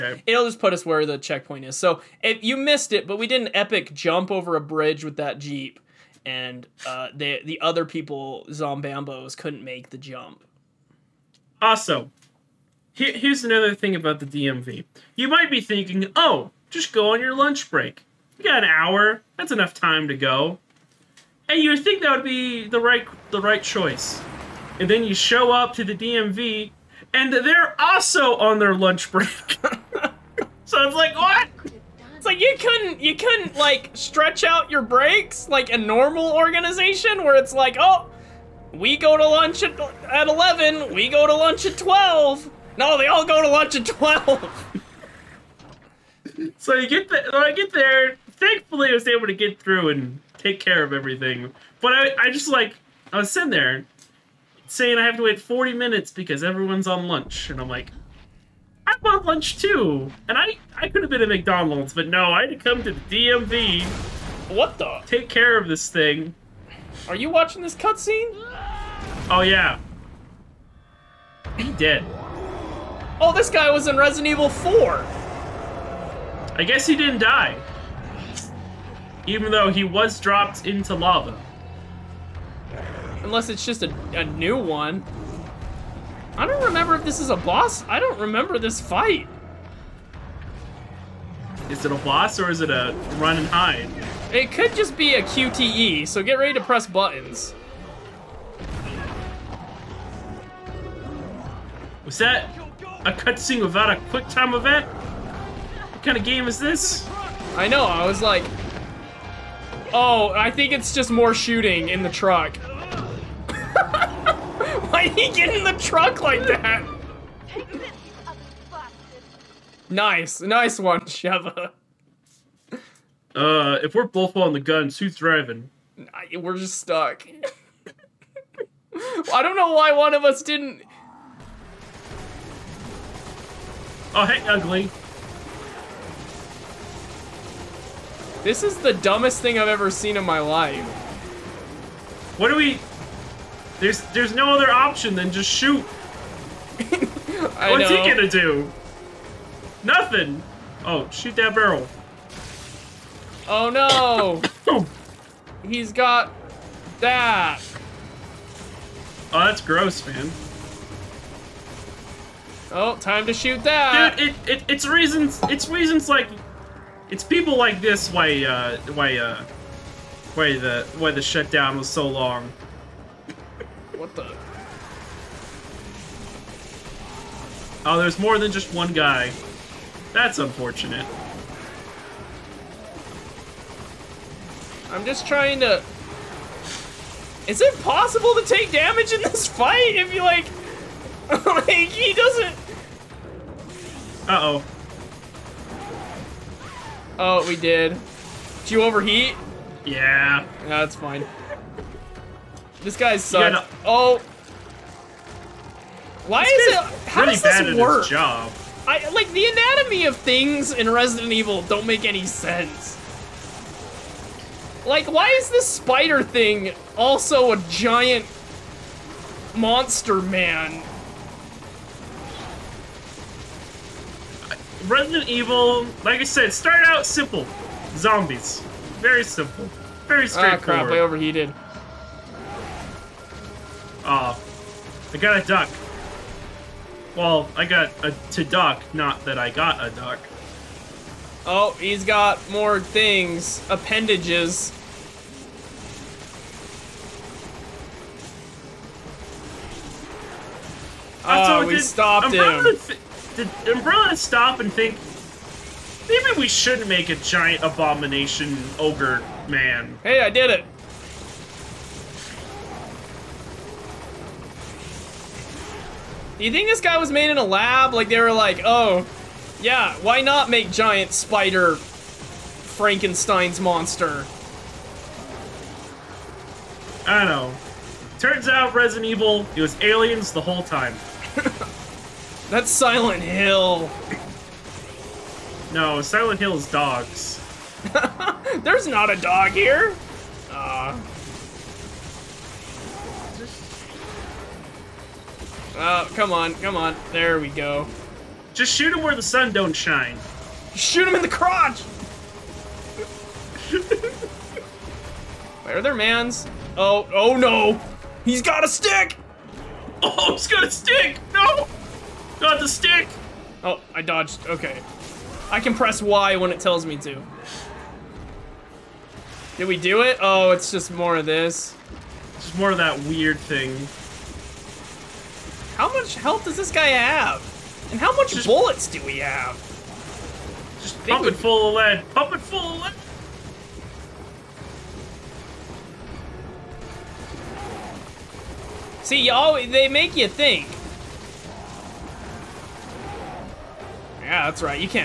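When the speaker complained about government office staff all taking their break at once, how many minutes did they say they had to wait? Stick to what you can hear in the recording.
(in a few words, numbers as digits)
40.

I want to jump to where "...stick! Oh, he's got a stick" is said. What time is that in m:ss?
5:08.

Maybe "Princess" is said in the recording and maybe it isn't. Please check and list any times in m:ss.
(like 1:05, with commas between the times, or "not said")
not said.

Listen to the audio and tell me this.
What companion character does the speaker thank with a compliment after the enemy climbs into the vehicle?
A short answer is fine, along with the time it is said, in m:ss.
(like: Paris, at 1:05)
Sheva, at 2:01.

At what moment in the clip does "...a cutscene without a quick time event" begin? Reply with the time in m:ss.
1:43.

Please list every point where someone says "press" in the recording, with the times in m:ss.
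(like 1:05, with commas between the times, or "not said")
1:36, 5:15.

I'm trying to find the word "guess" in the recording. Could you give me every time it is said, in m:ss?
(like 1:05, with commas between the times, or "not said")
1:16.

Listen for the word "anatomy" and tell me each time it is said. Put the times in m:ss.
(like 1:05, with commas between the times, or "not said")
3:29.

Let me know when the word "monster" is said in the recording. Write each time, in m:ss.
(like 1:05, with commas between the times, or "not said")
3:39, 4:33.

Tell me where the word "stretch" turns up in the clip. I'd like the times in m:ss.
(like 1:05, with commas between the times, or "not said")
0:33.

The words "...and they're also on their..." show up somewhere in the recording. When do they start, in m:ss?
0:27.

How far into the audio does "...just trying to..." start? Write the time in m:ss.
3:05.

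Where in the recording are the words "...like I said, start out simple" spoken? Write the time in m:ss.
3:46.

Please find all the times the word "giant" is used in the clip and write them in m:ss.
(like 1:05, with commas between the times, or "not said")
3:37, 4:17, 4:30.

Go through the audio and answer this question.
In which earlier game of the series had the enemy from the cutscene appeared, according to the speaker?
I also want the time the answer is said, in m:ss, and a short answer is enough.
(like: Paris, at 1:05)
Resident Evil 4, at 1:13.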